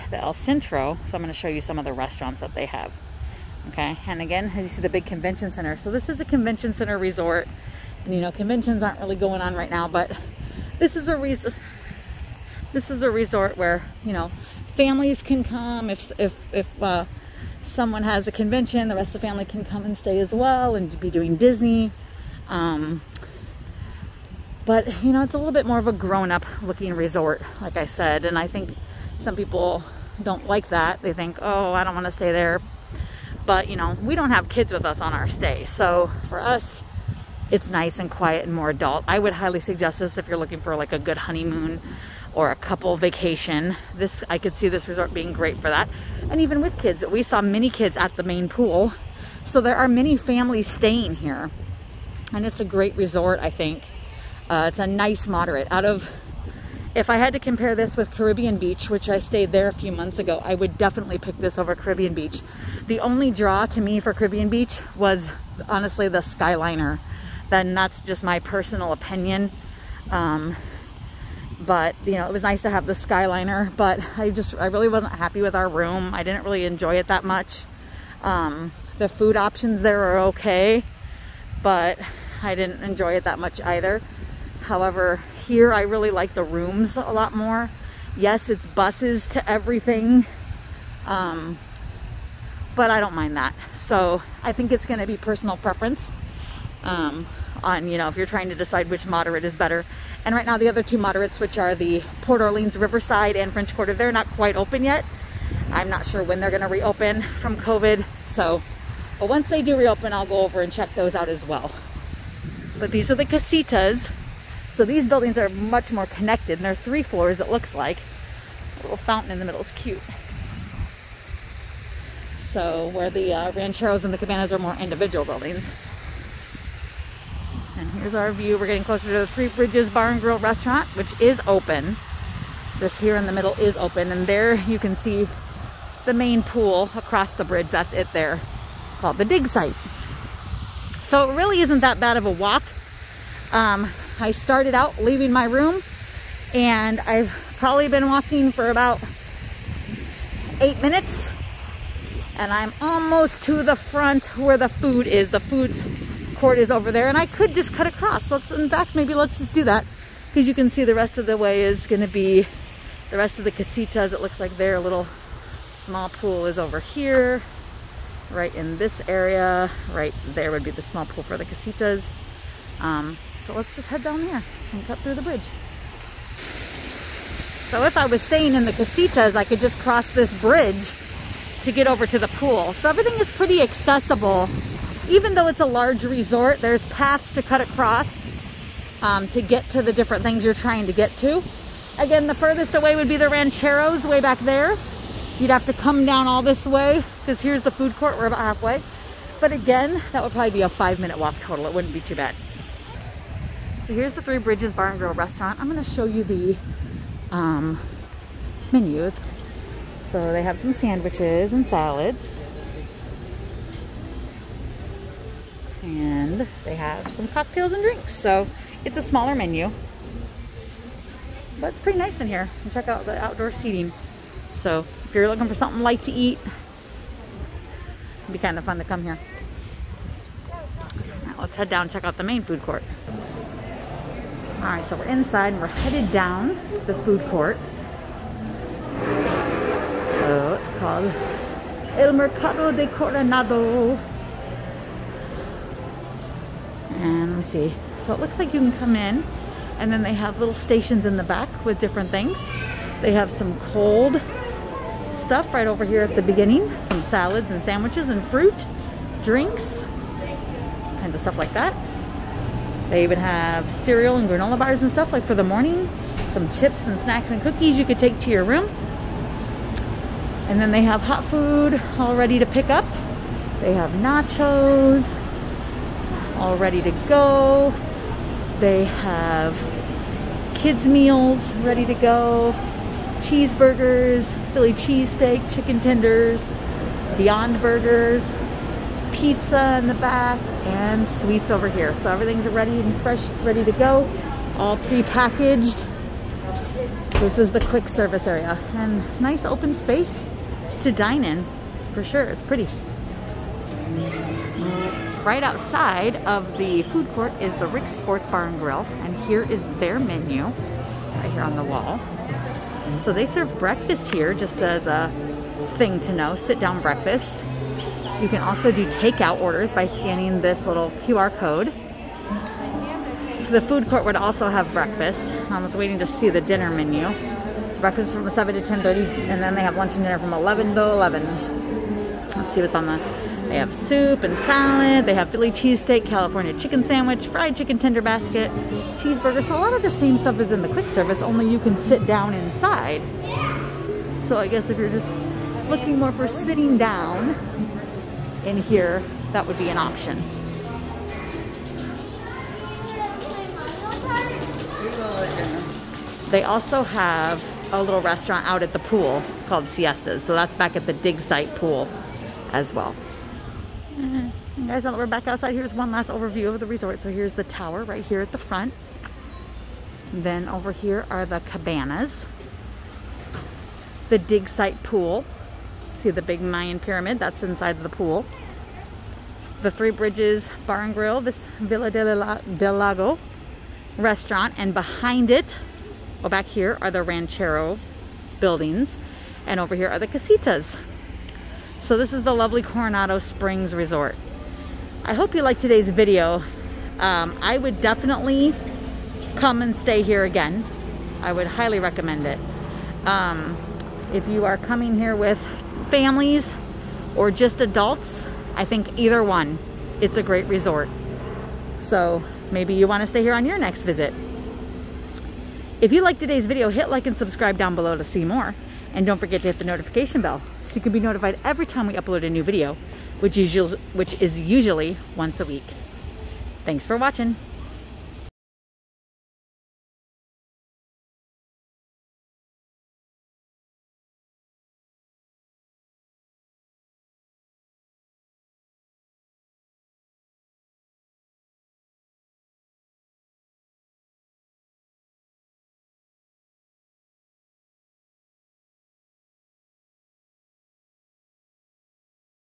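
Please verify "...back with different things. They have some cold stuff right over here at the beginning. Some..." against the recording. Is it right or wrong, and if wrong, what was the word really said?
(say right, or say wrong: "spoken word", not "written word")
right.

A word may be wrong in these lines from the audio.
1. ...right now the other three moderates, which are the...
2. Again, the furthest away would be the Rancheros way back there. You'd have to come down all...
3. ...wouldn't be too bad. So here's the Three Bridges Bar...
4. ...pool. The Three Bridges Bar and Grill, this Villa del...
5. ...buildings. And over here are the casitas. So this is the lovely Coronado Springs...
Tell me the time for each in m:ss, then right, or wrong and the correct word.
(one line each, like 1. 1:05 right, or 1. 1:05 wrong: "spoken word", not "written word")
1. 1:40 wrong: "two", not "three"
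2. 3:11 right
3. 3:21 right
4. 6:17 right
5. 6:28 right.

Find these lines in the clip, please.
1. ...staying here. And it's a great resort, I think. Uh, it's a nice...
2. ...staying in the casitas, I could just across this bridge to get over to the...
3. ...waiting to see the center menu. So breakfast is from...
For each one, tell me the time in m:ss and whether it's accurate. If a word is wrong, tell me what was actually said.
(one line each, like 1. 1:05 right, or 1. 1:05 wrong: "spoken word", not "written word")
1. 0:50 right
2. 2:58 wrong: "cross", not "across"
3. 5:25 wrong: "dinner", not "center".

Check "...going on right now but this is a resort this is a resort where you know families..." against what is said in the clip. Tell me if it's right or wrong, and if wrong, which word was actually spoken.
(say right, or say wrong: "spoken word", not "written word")
right.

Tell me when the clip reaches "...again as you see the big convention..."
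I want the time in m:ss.
0:04.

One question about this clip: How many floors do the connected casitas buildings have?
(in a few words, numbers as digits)
3.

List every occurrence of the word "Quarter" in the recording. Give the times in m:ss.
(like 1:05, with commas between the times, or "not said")
1:43.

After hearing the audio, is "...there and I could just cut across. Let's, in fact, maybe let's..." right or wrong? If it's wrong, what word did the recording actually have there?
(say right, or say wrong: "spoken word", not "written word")
right.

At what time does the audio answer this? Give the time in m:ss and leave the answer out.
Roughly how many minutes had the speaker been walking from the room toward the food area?
2:30.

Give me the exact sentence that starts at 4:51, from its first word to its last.
So everything's ready and fresh, ready to go, all pre-packaged.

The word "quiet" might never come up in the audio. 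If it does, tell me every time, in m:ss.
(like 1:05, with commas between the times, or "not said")
0:38.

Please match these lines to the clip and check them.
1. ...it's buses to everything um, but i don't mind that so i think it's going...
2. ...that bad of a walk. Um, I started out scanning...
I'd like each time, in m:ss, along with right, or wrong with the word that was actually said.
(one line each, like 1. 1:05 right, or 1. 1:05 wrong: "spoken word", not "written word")
1. 1:28 right
2. 2:21 wrong: "leaving", not "scanning".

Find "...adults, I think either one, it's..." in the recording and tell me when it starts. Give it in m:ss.
6:47.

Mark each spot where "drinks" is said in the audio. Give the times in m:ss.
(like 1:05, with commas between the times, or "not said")
3:37, 4:19.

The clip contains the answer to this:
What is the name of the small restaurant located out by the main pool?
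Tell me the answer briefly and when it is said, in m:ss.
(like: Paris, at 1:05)
Siestas, at 5:59.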